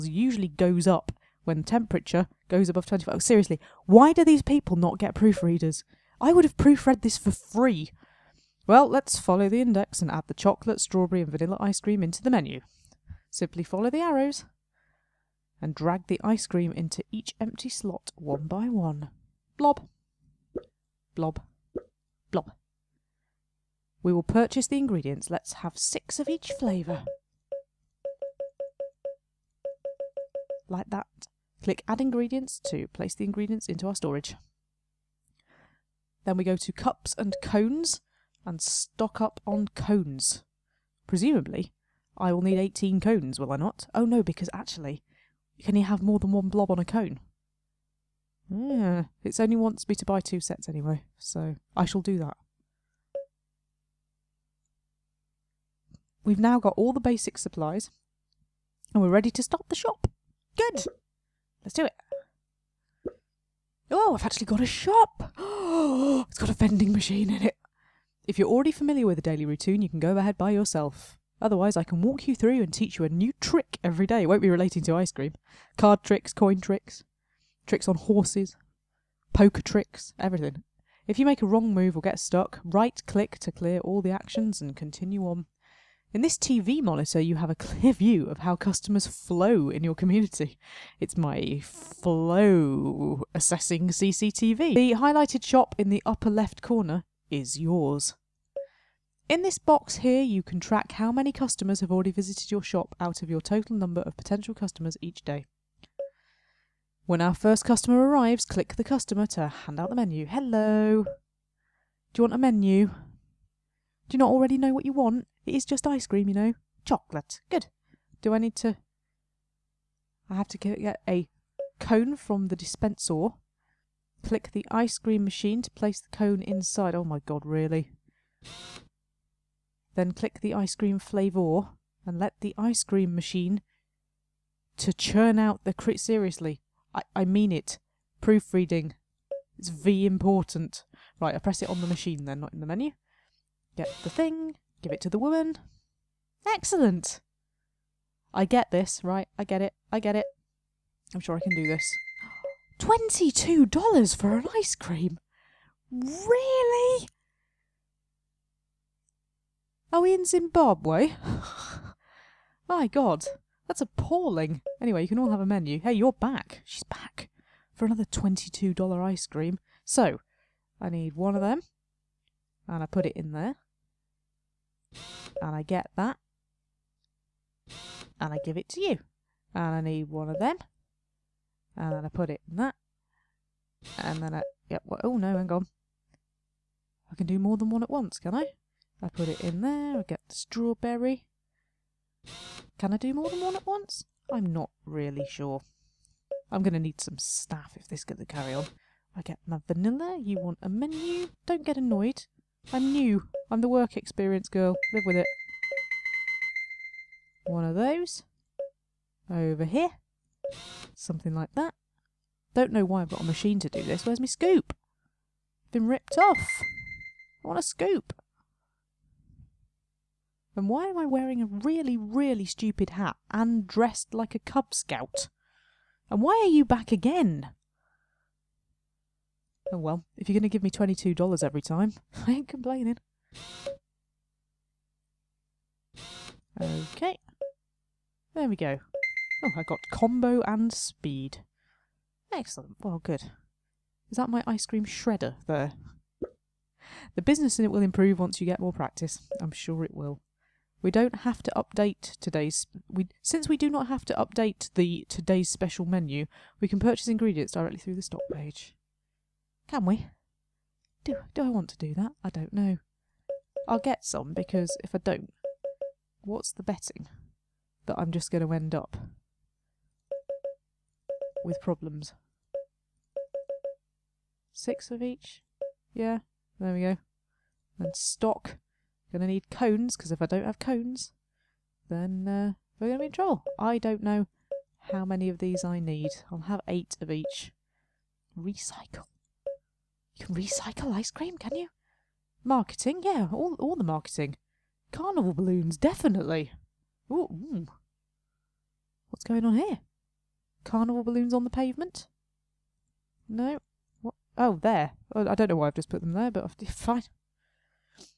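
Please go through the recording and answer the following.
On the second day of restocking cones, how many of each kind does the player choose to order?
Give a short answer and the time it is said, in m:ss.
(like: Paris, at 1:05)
8, at 4:46.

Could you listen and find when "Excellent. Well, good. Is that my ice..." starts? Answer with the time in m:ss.
4:02.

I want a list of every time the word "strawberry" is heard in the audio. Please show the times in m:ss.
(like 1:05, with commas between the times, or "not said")
0:10, 3:10.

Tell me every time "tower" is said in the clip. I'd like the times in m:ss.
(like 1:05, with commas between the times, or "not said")
not said.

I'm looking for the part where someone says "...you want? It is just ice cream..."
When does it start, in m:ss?
1:54.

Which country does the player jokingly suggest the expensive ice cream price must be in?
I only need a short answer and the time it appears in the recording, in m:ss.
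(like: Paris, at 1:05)
Zimbabwe, at 2:40.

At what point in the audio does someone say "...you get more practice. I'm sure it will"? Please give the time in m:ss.
4:08.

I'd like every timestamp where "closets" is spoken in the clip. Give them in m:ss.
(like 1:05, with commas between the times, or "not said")
not said.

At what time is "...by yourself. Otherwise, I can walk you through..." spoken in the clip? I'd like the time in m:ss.
1:10.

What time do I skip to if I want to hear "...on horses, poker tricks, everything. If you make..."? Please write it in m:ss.
1:17.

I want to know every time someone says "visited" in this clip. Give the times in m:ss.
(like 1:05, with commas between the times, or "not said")
1:42.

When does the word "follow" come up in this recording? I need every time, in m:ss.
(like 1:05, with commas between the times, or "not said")
0:09, 0:13.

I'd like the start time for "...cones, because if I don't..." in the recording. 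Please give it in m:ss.
4:39.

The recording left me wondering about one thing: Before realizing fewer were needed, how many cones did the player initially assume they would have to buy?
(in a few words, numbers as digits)
18.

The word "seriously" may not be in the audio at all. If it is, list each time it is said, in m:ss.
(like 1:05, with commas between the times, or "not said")
0:03, 2:15.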